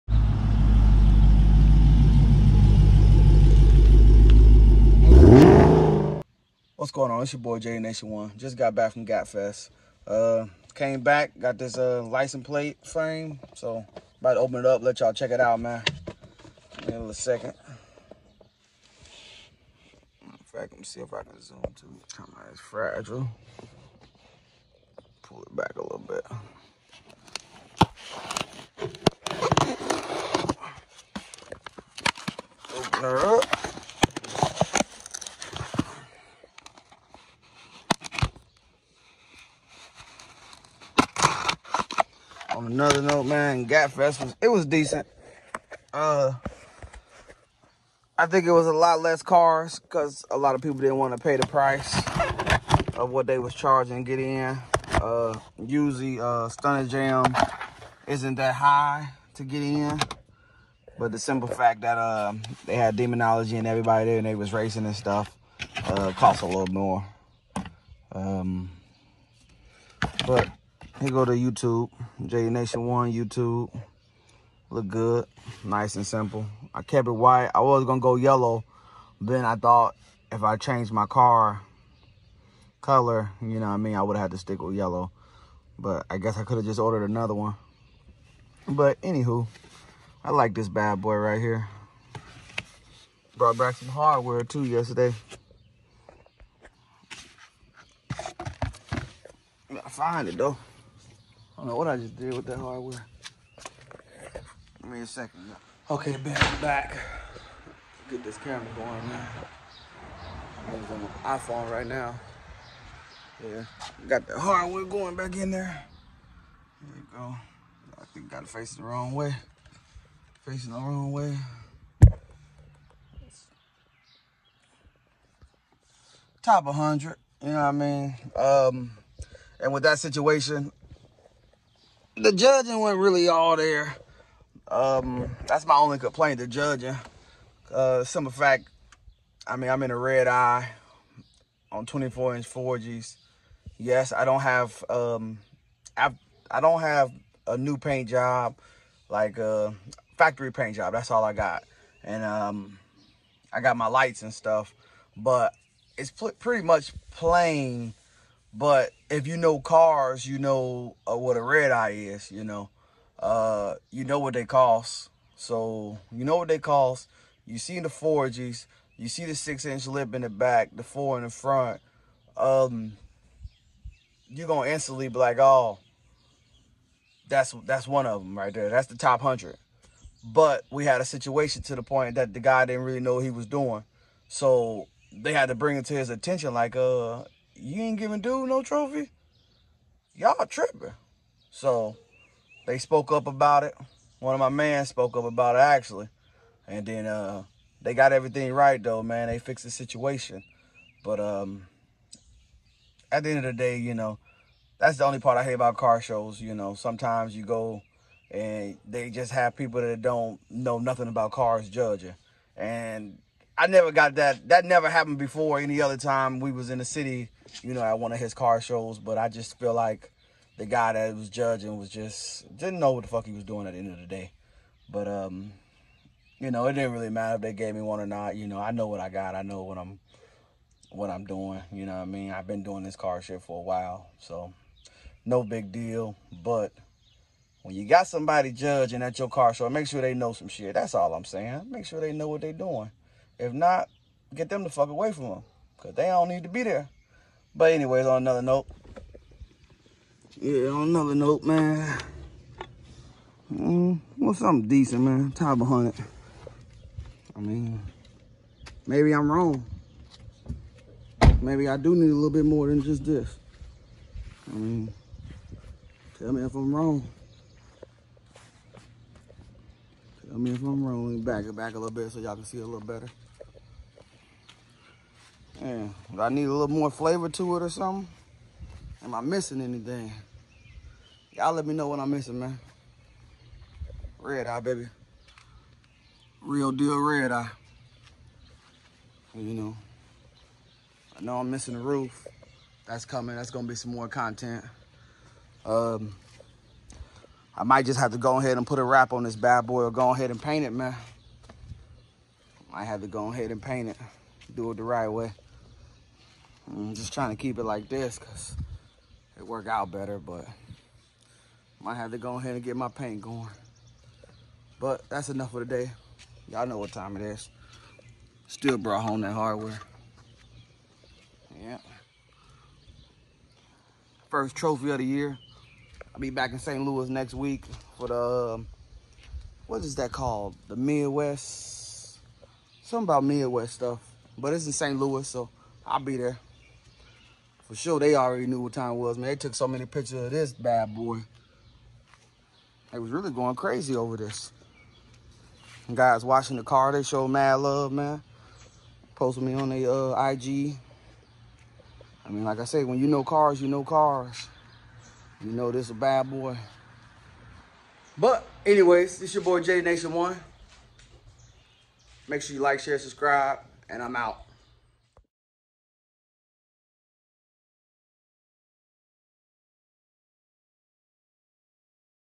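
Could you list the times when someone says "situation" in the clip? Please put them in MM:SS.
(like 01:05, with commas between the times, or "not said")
02:09, 03:01, 03:19.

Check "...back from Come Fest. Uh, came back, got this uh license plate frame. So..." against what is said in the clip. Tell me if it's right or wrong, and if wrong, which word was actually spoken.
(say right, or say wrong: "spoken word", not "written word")
wrong: "Gap", not "Come".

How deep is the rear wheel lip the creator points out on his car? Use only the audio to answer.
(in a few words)
6-inch.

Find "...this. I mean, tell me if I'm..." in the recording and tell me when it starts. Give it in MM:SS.
04:23.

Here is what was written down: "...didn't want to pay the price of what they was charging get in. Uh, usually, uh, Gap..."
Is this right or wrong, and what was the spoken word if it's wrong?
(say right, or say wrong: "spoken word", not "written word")
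wrong: "Stunna", not "Gap".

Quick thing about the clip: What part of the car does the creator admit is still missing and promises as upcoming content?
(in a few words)
the roof.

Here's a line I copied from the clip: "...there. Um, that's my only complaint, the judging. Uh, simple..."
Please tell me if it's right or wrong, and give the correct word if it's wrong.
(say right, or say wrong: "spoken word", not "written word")
right.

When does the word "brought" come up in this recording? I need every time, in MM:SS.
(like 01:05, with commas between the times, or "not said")
01:33, 05:18.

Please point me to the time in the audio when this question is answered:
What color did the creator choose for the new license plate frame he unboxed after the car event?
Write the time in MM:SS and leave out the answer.
01:16.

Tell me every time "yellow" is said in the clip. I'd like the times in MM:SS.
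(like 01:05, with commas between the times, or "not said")
01:18, 01:24.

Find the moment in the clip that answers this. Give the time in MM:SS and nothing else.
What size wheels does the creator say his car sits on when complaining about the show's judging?
02:21.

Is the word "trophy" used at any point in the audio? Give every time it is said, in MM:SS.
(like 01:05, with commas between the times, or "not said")
03:08, 05:24.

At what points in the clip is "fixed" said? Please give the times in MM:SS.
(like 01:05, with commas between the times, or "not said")
03:19.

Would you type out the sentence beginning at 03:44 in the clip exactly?
But um, you know, it didn't really matter if they gave me one or not.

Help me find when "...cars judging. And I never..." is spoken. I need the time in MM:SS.
03:31.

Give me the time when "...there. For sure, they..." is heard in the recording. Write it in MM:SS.
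05:36.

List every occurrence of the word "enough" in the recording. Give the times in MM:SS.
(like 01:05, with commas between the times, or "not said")
05:15.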